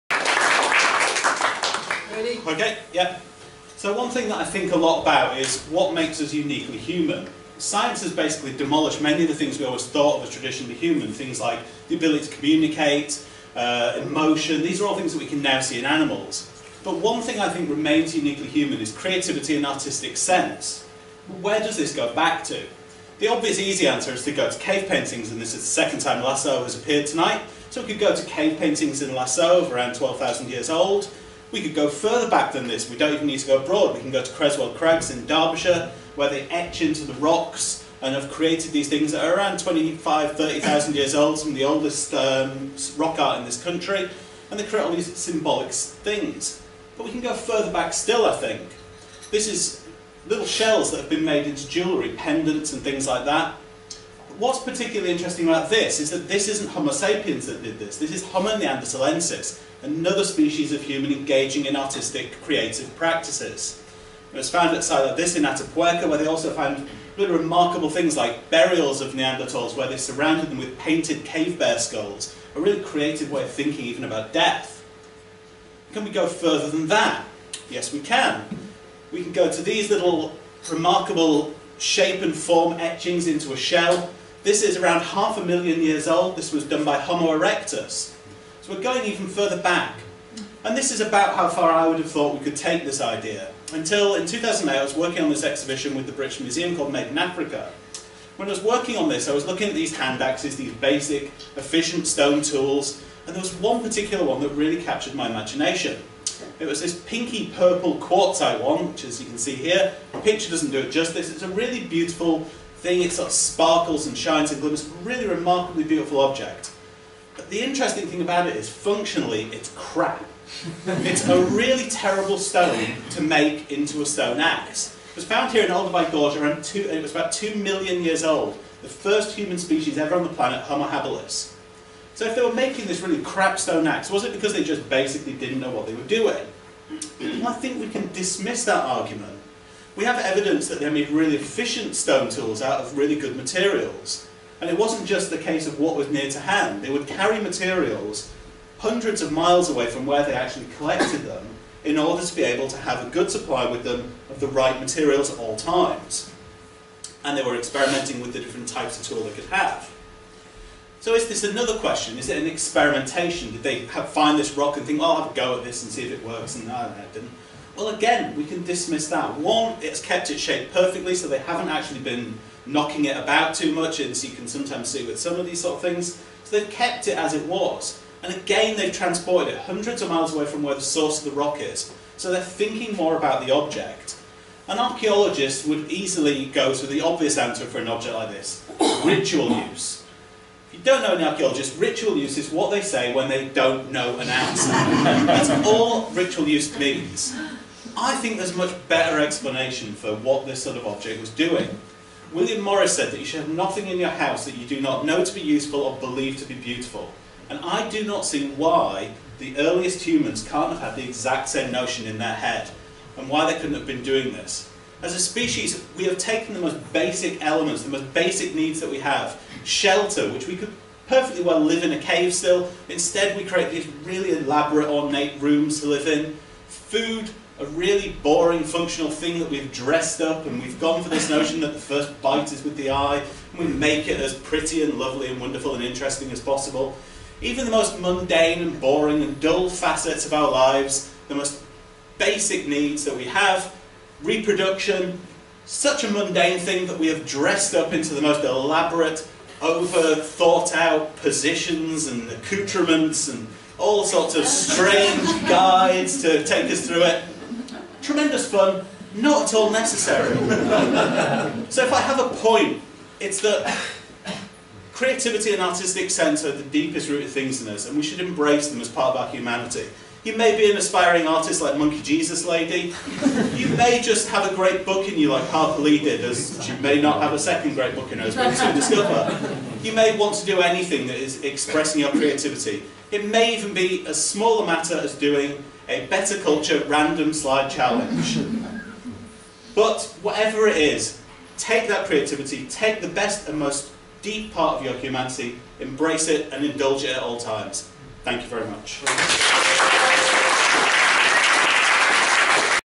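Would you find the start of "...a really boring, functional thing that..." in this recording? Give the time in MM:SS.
03:47.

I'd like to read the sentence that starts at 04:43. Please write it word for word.
It may even be as small a matter as doing a Bettakultcha random slide challenge.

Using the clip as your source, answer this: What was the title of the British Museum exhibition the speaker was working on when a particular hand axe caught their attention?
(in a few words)
Made in Africa.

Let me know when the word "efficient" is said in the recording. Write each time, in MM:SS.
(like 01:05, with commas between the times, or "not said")
01:41, 02:21.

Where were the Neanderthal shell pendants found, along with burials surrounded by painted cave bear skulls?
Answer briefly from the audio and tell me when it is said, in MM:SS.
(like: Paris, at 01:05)
Atapuerca, at 01:05.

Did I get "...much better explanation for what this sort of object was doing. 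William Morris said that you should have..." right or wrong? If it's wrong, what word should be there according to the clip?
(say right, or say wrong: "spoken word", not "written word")
right.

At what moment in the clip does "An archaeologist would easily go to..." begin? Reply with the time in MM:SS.
03:04.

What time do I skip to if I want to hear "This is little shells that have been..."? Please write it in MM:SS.
00:49.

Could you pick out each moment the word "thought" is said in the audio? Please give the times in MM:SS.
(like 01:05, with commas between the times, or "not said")
00:09, 01:32, 04:10.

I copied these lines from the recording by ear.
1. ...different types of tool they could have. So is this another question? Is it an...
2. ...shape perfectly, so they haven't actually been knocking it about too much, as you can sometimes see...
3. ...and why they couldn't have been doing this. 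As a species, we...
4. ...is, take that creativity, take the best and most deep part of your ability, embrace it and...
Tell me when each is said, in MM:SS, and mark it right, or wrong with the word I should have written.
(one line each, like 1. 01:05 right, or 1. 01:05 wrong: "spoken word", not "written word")
1. 02:38 right
2. 02:50 right
3. 03:33 right
4. 04:50 wrong: "humanity", not "ability".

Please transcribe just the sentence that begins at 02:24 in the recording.
And it wasn't just the case of what was near to hand.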